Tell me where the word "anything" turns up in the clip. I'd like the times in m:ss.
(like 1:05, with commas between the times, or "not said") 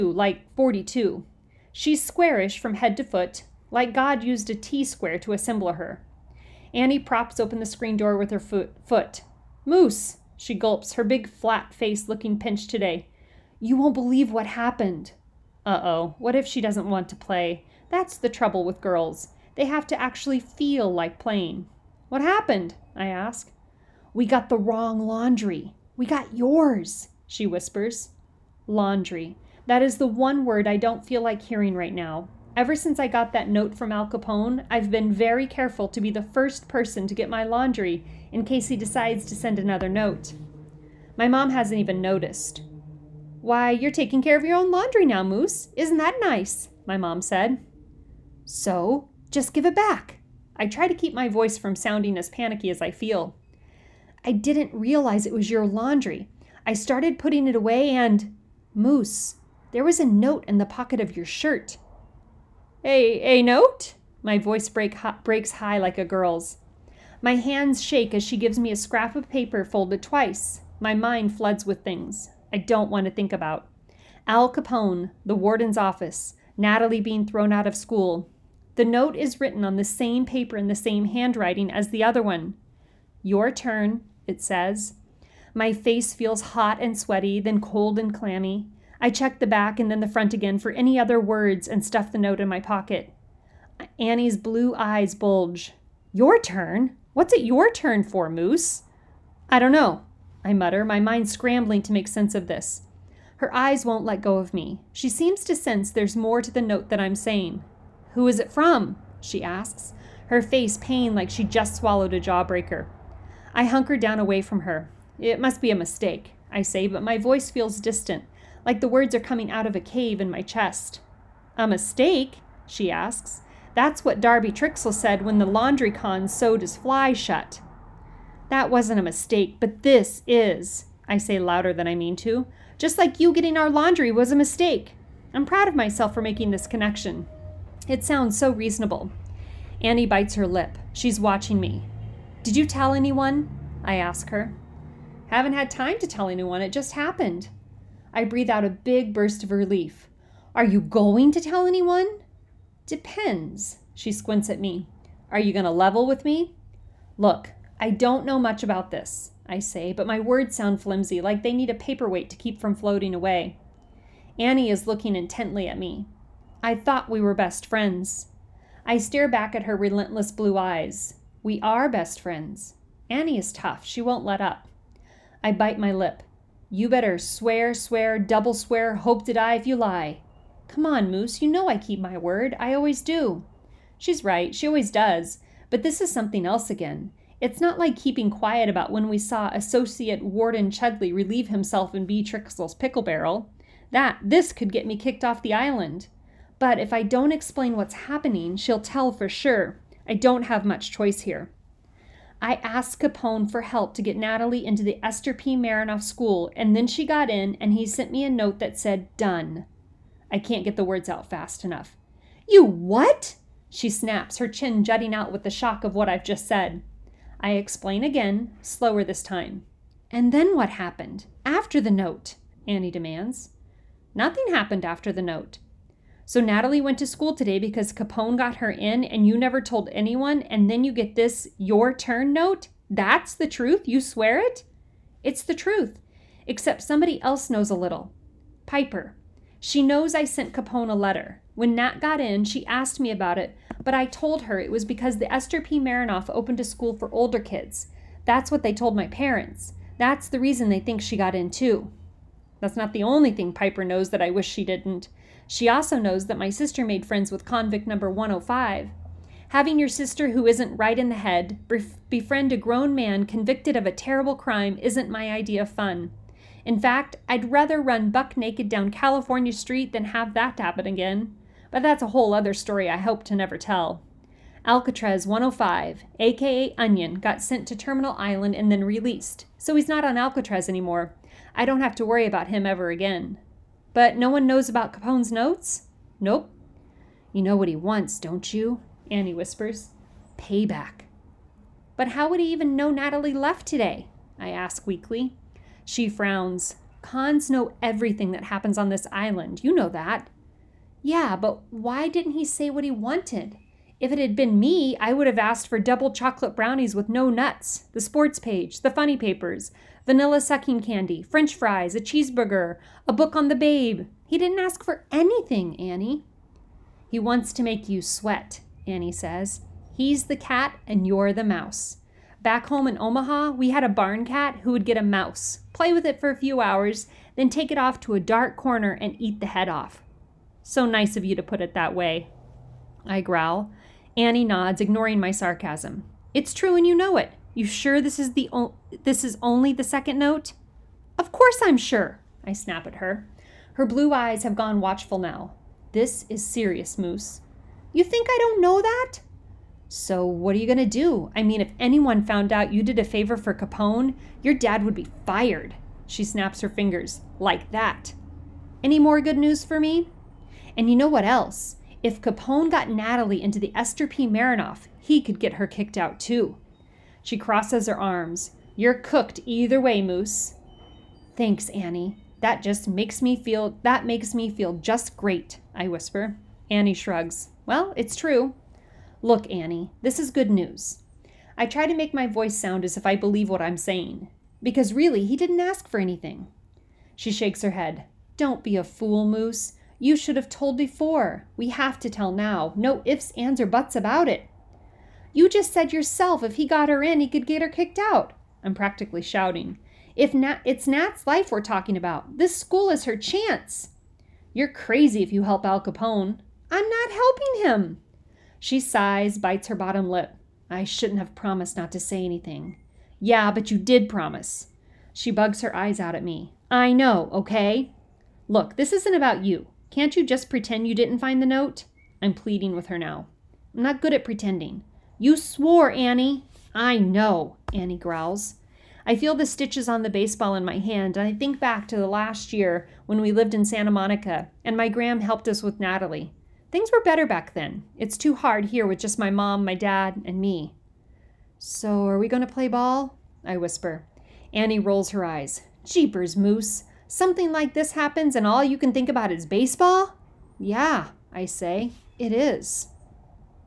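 5:15, 6:25, 6:52.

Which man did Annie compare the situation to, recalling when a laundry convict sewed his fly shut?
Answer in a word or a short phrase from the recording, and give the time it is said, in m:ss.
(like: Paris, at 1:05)
Darby Trixle, at 2:04.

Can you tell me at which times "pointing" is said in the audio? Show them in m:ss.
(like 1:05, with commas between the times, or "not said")
not said.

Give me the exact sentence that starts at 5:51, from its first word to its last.
I mean, if anyone found out you did a favor for Capone, your dad would be fired.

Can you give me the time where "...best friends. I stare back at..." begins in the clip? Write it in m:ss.
2:47.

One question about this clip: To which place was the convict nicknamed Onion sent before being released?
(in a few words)
Terminal Island.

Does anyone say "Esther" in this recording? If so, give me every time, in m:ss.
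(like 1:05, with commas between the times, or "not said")
3:25, 4:05, 6:03.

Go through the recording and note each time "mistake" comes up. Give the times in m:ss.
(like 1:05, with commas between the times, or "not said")
1:55, 2:01, 2:09, 2:14.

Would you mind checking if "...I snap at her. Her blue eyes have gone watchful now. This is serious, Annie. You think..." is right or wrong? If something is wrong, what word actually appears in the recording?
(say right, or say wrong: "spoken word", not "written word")
wrong: "Moose", not "Annie".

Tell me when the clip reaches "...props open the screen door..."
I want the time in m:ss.
0:06.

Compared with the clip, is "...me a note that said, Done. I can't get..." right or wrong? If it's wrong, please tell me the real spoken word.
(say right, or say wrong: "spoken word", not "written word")
right.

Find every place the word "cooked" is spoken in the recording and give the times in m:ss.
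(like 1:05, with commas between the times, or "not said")
6:08.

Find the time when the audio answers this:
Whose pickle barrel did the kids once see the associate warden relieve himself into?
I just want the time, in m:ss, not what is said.
3:12.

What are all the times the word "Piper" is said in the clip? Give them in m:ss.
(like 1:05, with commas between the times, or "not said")
3:58, 4:13.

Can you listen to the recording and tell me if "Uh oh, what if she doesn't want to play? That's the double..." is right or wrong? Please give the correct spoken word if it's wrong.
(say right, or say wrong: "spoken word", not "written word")
wrong: "trouble", not "double".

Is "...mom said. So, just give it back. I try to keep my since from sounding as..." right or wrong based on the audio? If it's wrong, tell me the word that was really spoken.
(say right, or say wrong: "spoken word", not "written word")
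wrong: "voice", not "since".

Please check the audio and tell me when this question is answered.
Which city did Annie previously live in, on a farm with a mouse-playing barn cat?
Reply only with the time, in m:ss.
5:23.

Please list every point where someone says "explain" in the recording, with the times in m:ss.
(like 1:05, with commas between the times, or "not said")
3:17, 3:37.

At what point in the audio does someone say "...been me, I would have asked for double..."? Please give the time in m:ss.
5:04.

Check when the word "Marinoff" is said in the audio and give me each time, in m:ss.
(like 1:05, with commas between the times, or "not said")
3:25, 4:05, 6:04.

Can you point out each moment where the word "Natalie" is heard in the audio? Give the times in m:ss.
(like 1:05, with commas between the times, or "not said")
1:16, 3:24, 3:46, 4:52, 6:02, 7:15.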